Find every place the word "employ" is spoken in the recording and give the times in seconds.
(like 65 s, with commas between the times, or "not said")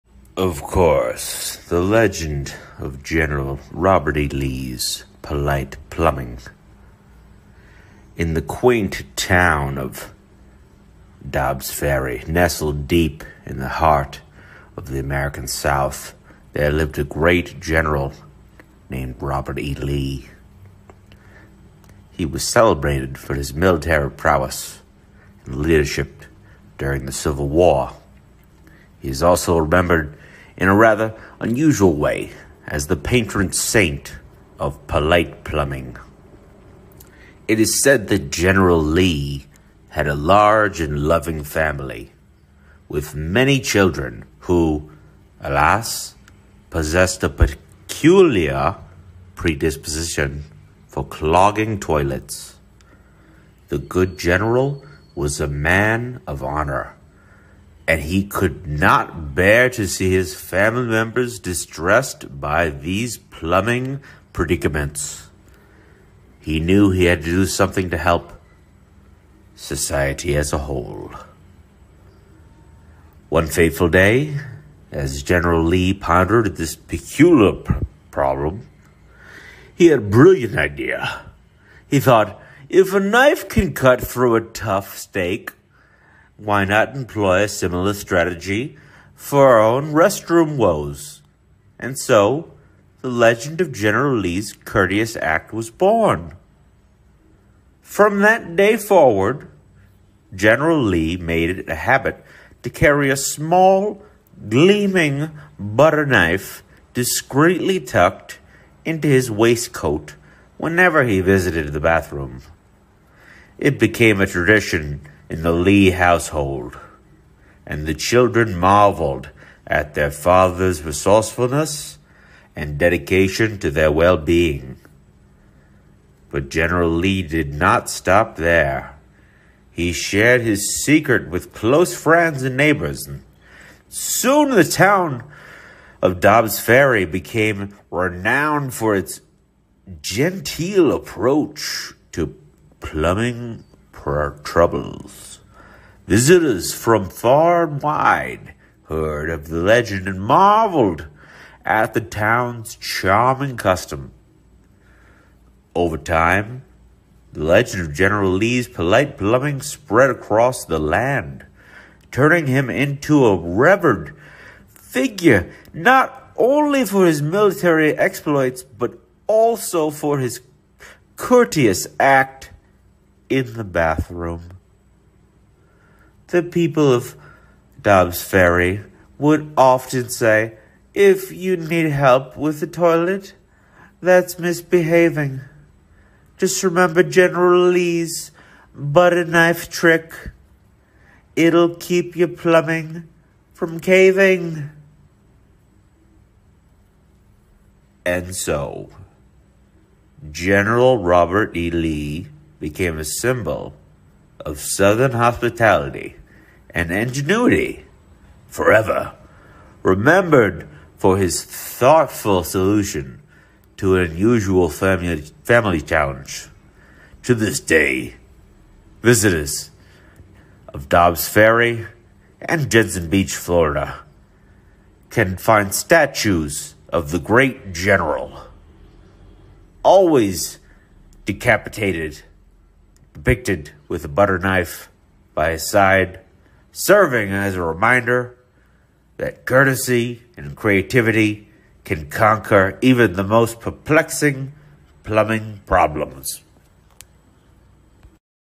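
86 s.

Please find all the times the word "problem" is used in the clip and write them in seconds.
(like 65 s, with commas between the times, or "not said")
78 s, 245 s.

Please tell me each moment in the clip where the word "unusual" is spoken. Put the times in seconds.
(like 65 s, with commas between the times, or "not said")
31 s, 214 s.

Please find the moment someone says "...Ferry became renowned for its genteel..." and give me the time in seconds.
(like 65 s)
136 s.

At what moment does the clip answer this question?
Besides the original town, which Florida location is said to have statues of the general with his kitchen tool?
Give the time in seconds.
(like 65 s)
222 s.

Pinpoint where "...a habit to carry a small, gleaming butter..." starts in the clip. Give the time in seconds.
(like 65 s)
101 s.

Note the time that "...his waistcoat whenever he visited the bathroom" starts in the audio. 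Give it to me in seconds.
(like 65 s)
109 s.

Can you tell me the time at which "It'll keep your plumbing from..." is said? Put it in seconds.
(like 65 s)
191 s.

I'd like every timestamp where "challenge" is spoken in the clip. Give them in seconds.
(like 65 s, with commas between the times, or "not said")
215 s.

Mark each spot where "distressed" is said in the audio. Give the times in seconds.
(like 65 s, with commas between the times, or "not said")
61 s.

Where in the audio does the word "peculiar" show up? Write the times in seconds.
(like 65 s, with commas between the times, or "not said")
47 s, 76 s.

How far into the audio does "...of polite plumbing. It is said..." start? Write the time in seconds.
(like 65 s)
34 s.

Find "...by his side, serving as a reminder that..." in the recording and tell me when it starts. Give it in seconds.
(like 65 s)
235 s.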